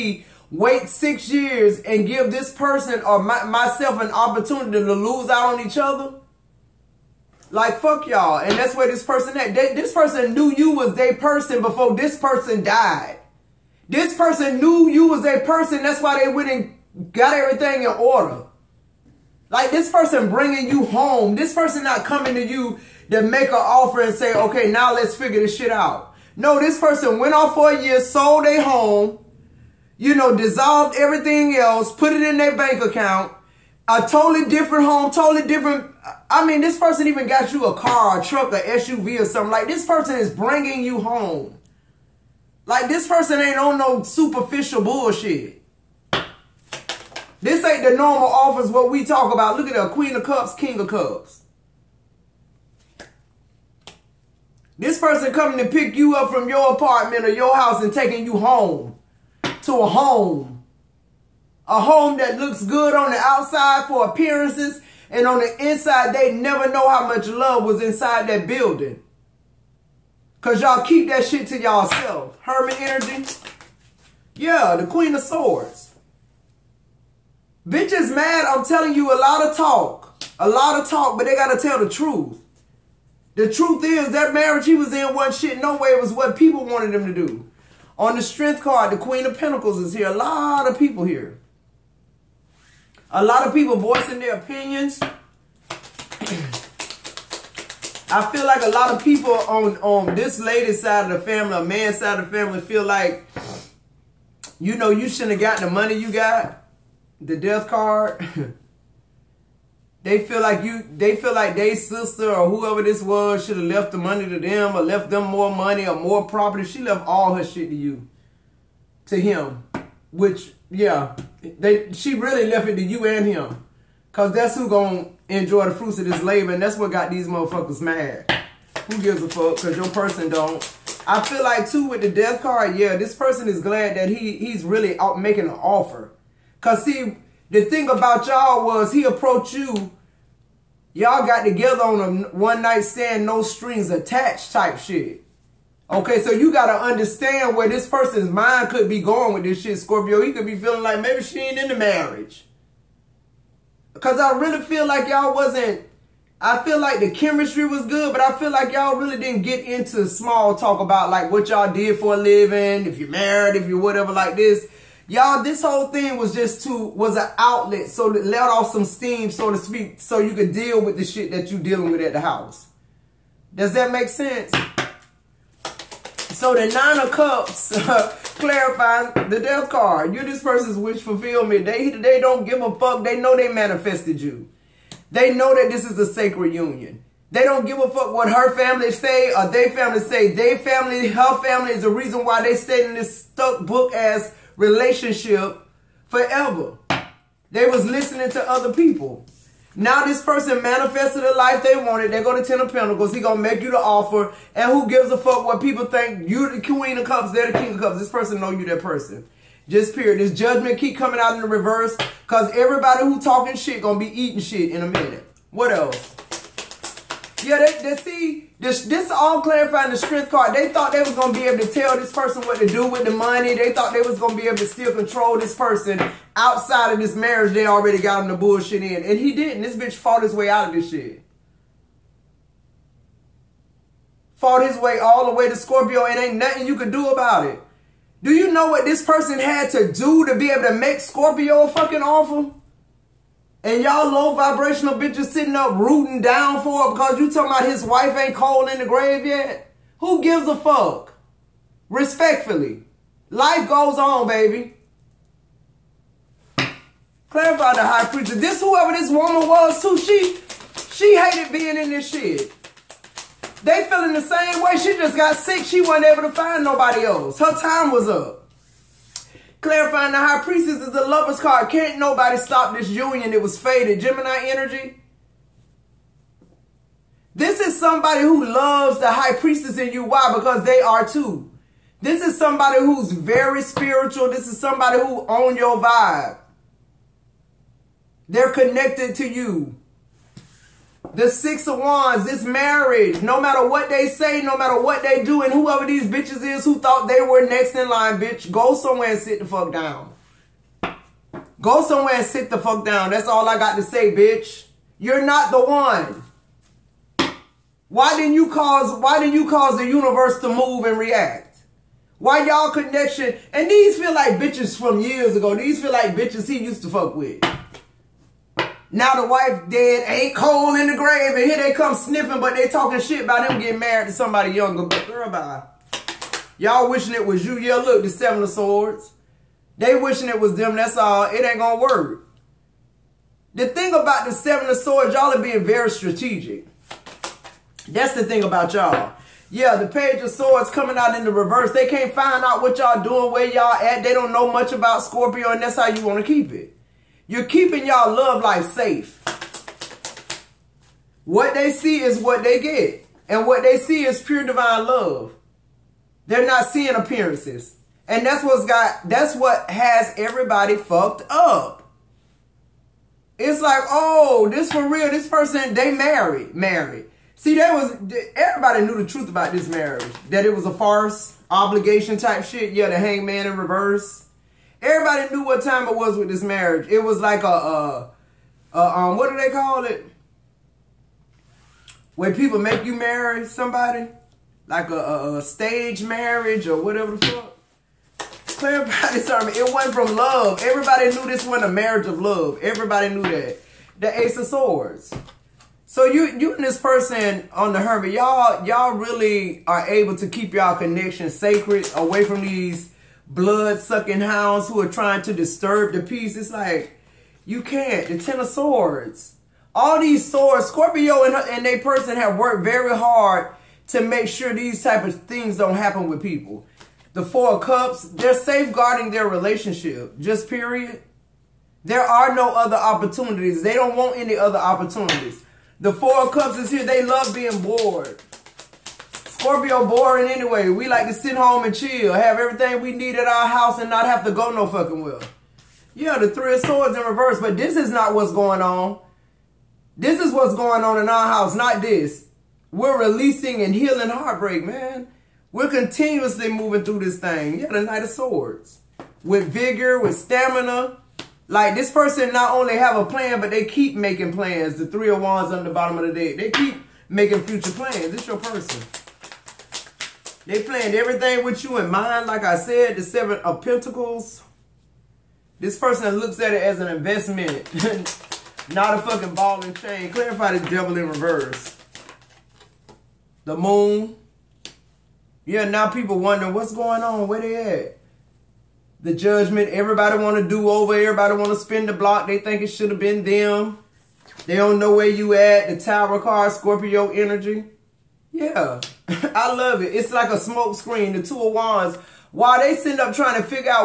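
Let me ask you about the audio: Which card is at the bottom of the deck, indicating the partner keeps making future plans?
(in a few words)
Three of Wands.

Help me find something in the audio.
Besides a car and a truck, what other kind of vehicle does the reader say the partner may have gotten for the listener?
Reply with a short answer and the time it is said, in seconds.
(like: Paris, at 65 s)
SUV, at 38 s.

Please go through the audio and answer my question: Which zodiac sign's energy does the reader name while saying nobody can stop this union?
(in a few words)
Gemini.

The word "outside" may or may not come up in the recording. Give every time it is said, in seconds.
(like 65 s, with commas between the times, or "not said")
63 s, 226 s.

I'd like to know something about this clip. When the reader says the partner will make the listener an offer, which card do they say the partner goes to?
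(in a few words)
Ten of Pentacles.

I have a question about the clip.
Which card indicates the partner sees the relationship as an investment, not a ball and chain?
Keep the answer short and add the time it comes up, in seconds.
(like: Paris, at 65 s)
Seven of Pentacles, at 463 s.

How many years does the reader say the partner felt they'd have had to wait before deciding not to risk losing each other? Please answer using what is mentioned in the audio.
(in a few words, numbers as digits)
6.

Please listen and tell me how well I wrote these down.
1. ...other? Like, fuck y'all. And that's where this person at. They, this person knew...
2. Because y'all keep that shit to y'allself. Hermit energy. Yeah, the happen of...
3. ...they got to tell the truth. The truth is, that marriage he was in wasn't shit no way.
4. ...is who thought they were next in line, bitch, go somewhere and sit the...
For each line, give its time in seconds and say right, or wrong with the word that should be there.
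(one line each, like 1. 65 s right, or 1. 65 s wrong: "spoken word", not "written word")
1. 5 s right
2. 70 s wrong: "queen", not "happen"
3. 81 s right
4. 296 s right.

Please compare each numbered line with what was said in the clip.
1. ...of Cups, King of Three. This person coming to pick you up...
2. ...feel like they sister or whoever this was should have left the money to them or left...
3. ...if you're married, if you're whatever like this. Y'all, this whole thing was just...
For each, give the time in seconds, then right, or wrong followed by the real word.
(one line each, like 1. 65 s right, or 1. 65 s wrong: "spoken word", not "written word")
1. 50 s wrong: "Cups", not "Three"
2. 111 s right
3. 162 s right.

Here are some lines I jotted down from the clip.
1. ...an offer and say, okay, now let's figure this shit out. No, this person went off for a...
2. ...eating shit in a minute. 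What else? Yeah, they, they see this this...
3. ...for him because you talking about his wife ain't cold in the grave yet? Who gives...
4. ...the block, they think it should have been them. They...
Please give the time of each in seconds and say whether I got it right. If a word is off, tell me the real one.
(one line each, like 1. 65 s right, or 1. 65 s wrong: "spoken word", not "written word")
1. 23 s right
2. 214 s right
3. 246 s right
4. 481 s right.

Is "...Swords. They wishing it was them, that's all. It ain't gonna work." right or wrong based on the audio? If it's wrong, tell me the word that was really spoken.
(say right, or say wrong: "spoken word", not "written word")
right.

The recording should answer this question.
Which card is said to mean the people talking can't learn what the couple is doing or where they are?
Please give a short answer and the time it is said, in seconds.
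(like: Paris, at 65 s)
Page of Swords, at 339 s.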